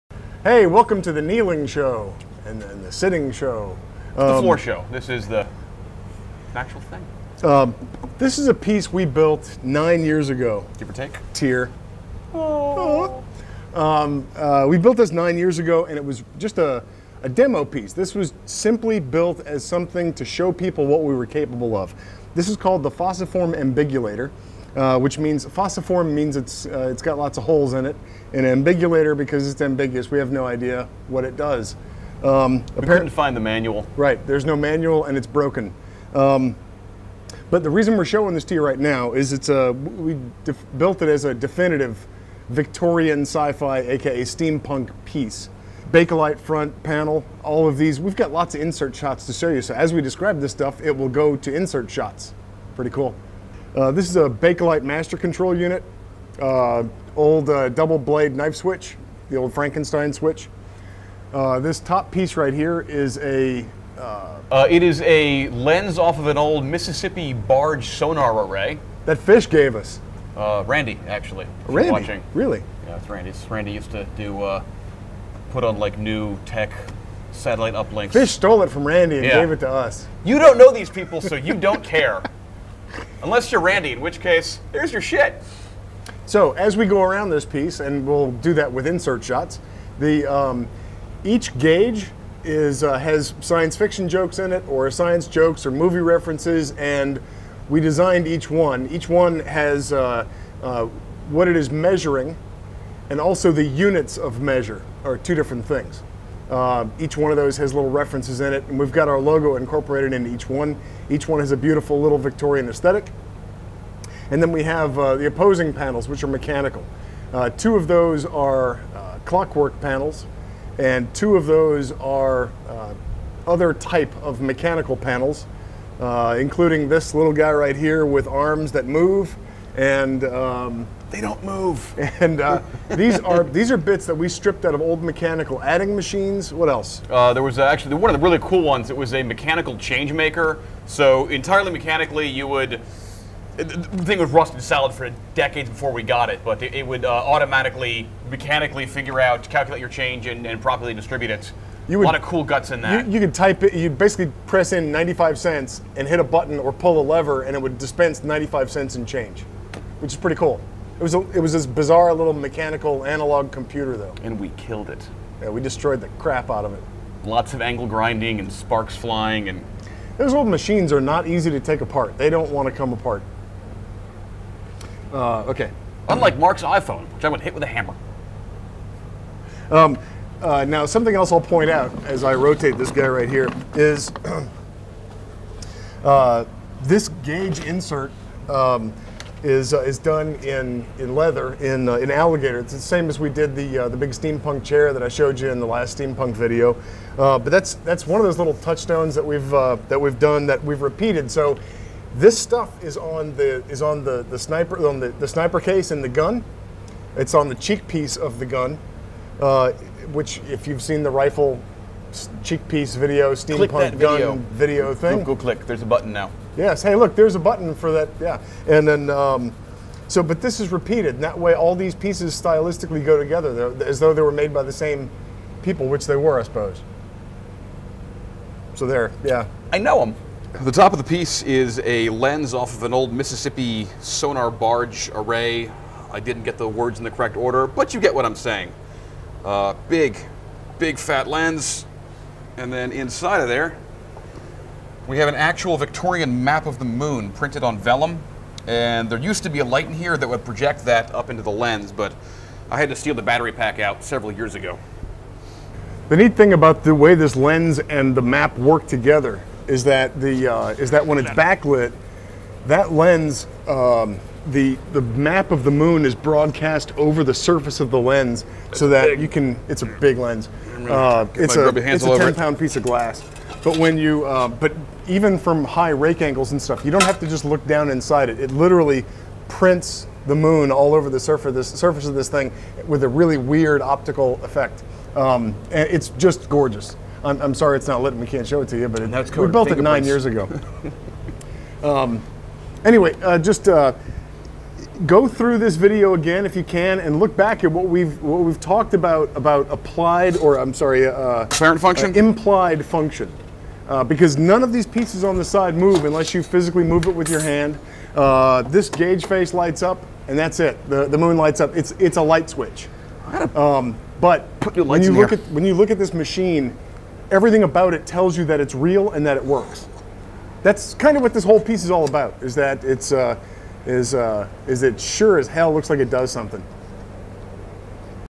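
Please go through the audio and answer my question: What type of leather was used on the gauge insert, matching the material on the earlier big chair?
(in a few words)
Alligator.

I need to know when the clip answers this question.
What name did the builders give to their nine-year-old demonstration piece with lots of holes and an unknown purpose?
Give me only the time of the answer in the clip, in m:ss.
0:22.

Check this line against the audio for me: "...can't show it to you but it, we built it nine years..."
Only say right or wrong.
right.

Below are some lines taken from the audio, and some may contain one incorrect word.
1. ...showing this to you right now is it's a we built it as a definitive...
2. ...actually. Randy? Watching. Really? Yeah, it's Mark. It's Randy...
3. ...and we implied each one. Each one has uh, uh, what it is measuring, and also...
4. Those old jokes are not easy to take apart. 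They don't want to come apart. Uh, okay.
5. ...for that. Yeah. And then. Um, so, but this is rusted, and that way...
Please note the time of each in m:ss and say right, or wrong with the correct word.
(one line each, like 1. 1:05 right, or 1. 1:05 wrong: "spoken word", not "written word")
1. 0:38 right
2. 1:11 wrong: "Randy", not "Mark"
3. 1:36 wrong: "designed", not "implied"
4. 2:50 wrong: "machines", not "jokes"
5. 3:37 wrong: "repeated", not "rusted".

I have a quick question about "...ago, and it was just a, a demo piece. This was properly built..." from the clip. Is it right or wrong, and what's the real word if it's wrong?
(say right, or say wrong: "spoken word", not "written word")
wrong: "simply", not "properly".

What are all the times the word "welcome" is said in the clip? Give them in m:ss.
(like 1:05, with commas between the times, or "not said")
0:00.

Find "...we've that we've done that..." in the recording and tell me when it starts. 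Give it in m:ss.
3:19.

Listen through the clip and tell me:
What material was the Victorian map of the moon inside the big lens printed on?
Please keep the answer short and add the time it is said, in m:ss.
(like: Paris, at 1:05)
Vellum, at 4:07.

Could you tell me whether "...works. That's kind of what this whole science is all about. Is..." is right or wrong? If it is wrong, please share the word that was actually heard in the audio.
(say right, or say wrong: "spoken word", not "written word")
wrong: "piece", not "science".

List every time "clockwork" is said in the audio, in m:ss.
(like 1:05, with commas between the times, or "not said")
1:59.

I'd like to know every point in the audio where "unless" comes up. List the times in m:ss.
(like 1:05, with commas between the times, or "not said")
1:23, 5:06.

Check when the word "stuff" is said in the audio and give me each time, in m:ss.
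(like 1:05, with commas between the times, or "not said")
0:50, 3:22, 4:36.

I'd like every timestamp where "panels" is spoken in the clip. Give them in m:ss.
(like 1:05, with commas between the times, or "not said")
0:46, 1:55, 1:59, 2:04.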